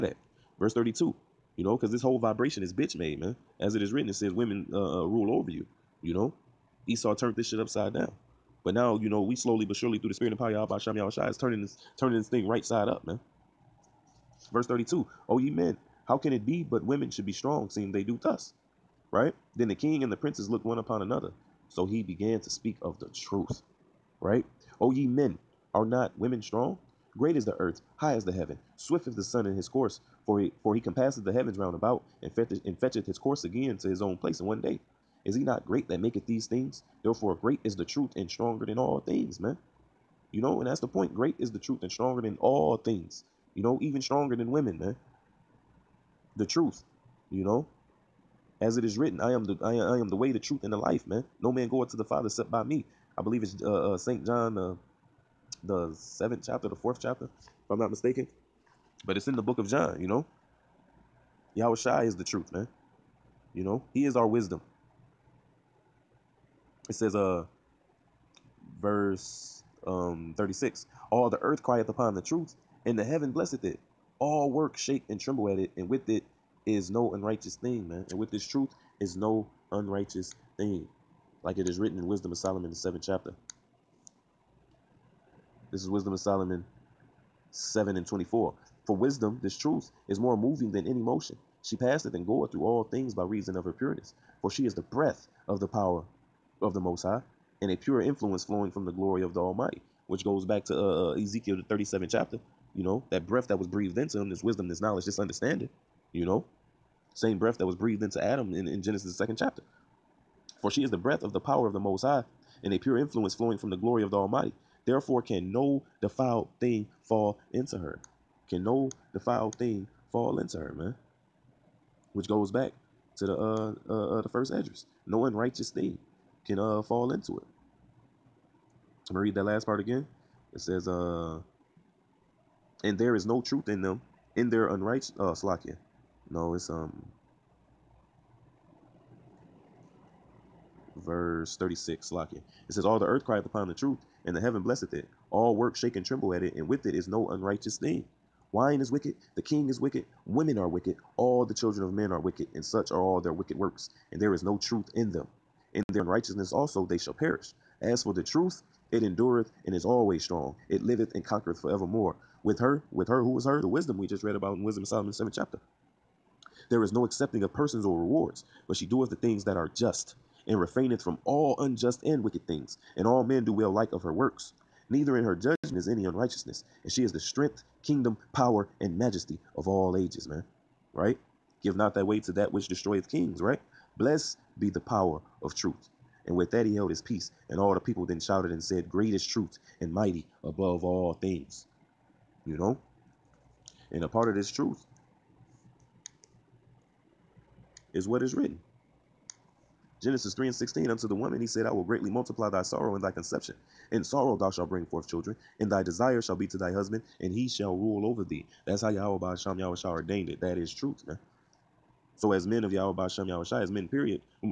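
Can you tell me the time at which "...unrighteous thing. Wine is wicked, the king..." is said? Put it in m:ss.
2:27.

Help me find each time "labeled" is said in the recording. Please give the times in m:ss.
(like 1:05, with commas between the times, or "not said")
not said.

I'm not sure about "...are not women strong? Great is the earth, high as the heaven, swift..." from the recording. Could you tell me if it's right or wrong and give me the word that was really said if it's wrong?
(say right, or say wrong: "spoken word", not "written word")
right.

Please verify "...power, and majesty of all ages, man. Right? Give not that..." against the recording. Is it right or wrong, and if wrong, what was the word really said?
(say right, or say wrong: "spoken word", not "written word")
right.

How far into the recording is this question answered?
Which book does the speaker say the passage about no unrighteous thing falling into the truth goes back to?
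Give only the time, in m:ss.
2:04.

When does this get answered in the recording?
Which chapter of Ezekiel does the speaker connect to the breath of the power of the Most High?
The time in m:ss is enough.
1:41.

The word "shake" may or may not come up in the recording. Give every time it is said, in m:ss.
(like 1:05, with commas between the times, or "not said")
1:14, 2:25.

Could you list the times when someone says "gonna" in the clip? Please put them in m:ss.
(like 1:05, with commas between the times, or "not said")
2:09.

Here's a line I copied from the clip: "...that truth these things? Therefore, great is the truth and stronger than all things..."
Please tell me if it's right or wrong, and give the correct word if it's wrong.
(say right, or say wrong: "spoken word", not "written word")
wrong: "maketh", not "truth".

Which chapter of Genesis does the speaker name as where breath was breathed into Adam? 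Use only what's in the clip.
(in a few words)
Second chapter.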